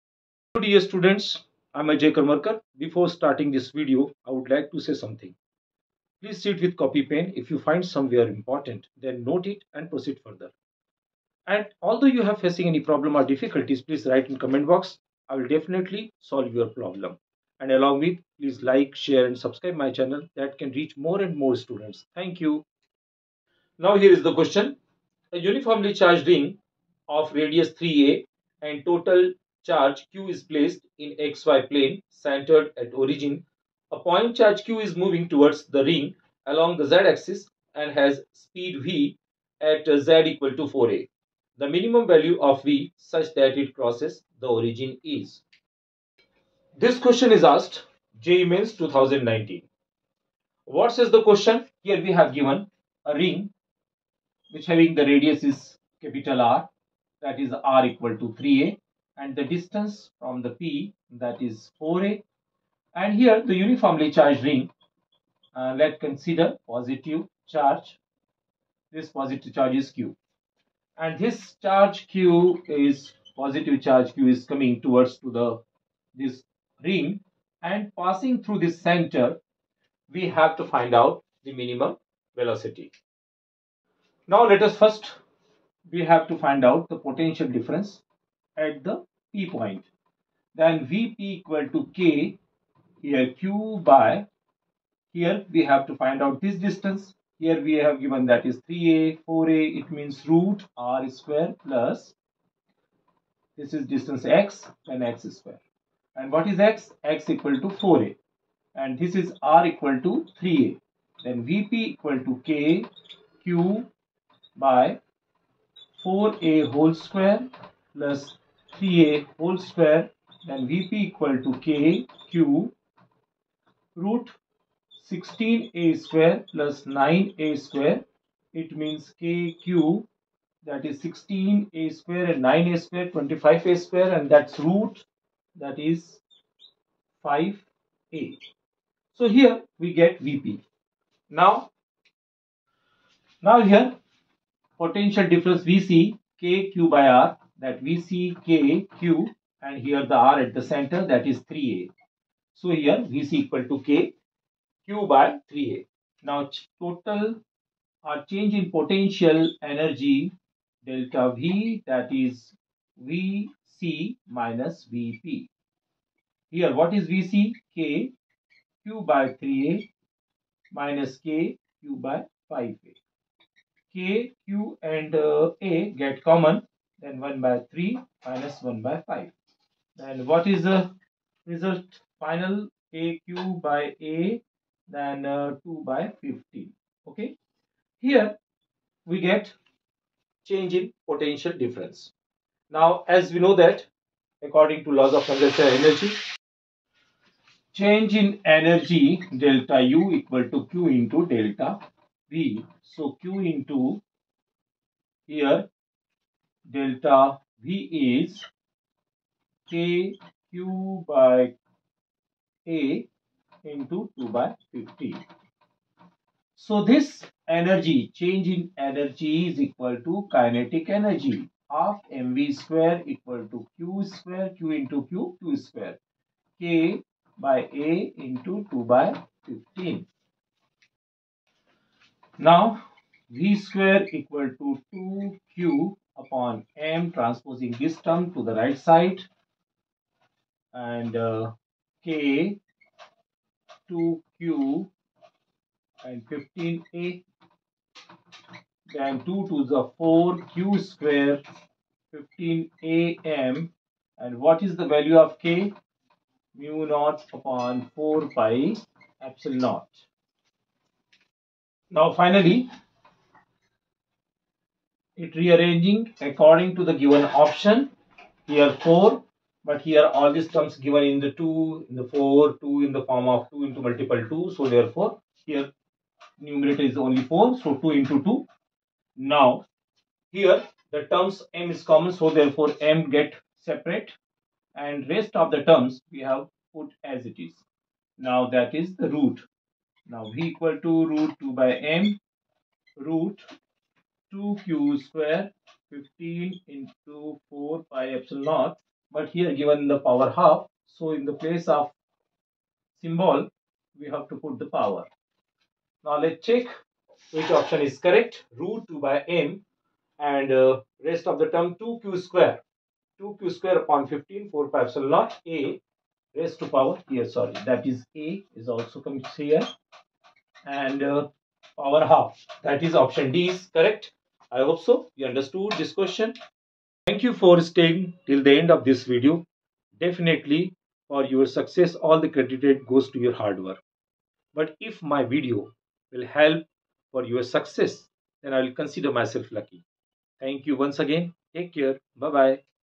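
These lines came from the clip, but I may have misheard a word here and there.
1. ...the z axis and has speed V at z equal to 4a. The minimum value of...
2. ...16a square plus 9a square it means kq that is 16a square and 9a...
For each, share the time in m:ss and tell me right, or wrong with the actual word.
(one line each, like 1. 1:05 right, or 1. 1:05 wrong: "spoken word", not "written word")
1. 0:36 right
2. 2:05 right.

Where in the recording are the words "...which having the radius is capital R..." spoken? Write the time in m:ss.
0:54.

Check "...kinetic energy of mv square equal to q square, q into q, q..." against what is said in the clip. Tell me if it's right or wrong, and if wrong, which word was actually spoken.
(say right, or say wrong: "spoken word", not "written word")
right.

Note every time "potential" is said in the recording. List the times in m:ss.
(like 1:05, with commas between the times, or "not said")
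1:26, 2:24, 2:38, 3:11.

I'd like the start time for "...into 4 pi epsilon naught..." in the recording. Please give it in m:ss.
4:56.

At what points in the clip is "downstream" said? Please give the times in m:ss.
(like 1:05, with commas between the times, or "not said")
not said.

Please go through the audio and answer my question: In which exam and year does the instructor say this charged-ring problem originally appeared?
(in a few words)
JEE Mains 2019.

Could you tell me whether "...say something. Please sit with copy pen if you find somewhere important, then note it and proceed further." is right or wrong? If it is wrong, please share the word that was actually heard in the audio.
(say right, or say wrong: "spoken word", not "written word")
right.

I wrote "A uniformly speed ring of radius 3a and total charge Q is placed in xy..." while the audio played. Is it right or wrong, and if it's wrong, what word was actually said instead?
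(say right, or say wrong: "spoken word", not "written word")
wrong: "charged", not "speed".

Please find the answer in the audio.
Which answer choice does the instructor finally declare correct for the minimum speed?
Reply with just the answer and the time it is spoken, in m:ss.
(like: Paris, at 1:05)
Option D, at 5:23.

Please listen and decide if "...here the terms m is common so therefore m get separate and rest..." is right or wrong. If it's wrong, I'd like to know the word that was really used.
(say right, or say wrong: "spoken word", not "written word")
right.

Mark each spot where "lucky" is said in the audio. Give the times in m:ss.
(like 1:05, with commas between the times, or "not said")
5:39.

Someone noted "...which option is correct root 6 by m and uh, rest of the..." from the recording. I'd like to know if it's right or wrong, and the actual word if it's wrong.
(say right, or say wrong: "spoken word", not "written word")
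wrong: "2", not "6".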